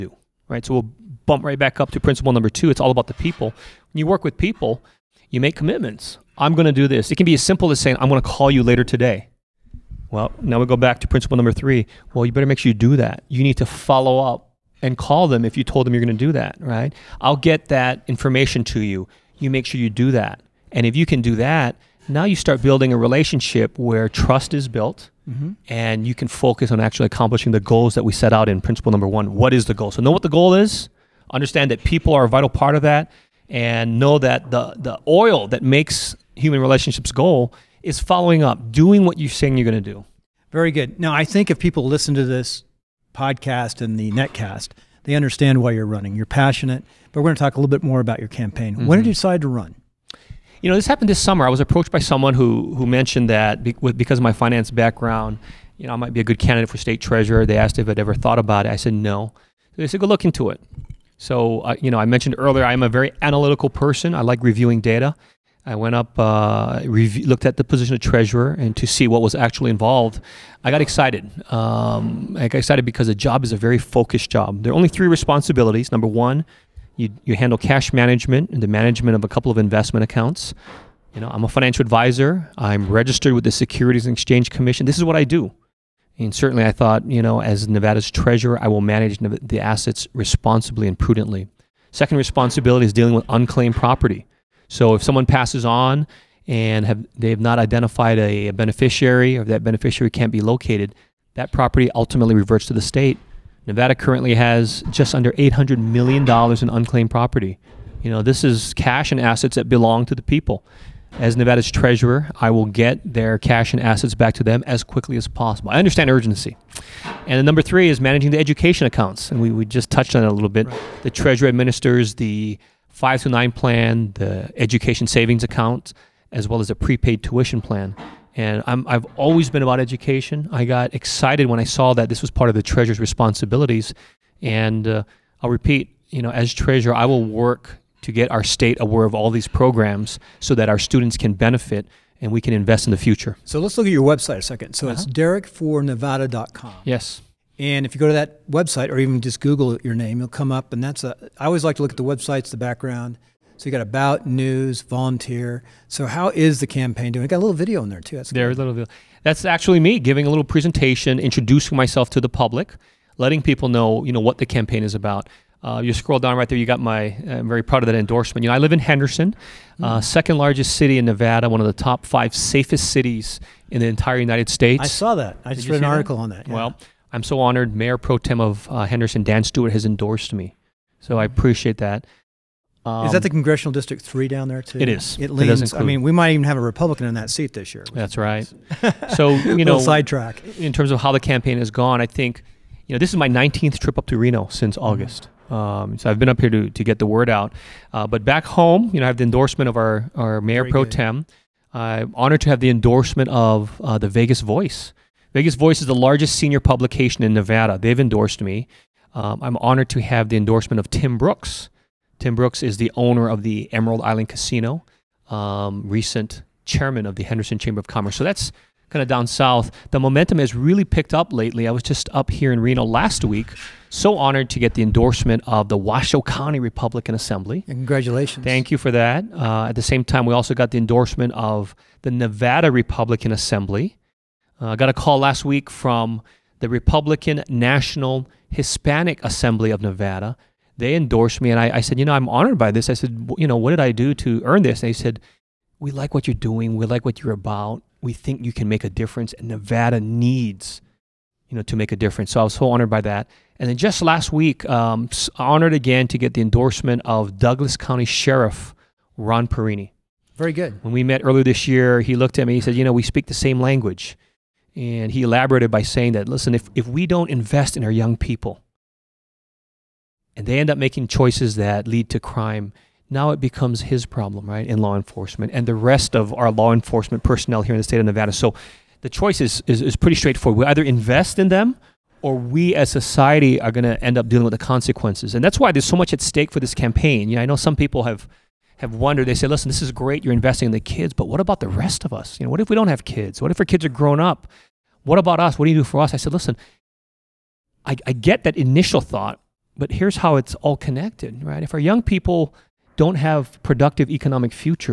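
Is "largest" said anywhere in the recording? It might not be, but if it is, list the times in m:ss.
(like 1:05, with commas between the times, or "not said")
2:50, 3:25.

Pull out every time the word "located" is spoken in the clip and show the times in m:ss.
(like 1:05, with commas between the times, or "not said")
1:40.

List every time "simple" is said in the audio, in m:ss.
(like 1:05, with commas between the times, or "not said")
0:07.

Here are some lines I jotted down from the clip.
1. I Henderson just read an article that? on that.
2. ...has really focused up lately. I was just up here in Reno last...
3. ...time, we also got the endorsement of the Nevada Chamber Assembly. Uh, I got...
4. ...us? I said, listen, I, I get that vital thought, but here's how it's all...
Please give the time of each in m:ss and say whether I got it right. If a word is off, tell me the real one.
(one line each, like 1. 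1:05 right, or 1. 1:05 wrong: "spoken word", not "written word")
1. 2:55 wrong: "Did", not "Henderson"
2. 3:40 wrong: "picked", not "focused"
3. 3:50 wrong: "Republican", not "Chamber"
4. 4:56 wrong: "initial", not "vital".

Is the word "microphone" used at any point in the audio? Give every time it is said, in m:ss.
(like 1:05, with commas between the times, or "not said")
not said.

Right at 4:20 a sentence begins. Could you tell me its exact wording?
When we met earlier this year, he looked at me, he said, you know, we speak the same language.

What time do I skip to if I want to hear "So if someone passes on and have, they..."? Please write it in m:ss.
1:34.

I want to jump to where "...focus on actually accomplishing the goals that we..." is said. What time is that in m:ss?
0:26.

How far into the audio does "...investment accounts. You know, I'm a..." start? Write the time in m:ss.
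1:19.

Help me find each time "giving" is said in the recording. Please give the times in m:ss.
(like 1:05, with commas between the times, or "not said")
2:39.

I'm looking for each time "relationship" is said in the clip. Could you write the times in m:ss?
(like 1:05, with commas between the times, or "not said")
0:22, 0:36.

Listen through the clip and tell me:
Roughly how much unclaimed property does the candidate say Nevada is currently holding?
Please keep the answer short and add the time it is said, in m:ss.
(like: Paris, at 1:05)
just under $800 million, at 1:44.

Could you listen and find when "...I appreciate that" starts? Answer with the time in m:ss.
3:01.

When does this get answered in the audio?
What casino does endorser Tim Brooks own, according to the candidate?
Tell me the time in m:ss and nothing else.
3:33.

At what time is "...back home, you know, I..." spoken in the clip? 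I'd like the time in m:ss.
3:18.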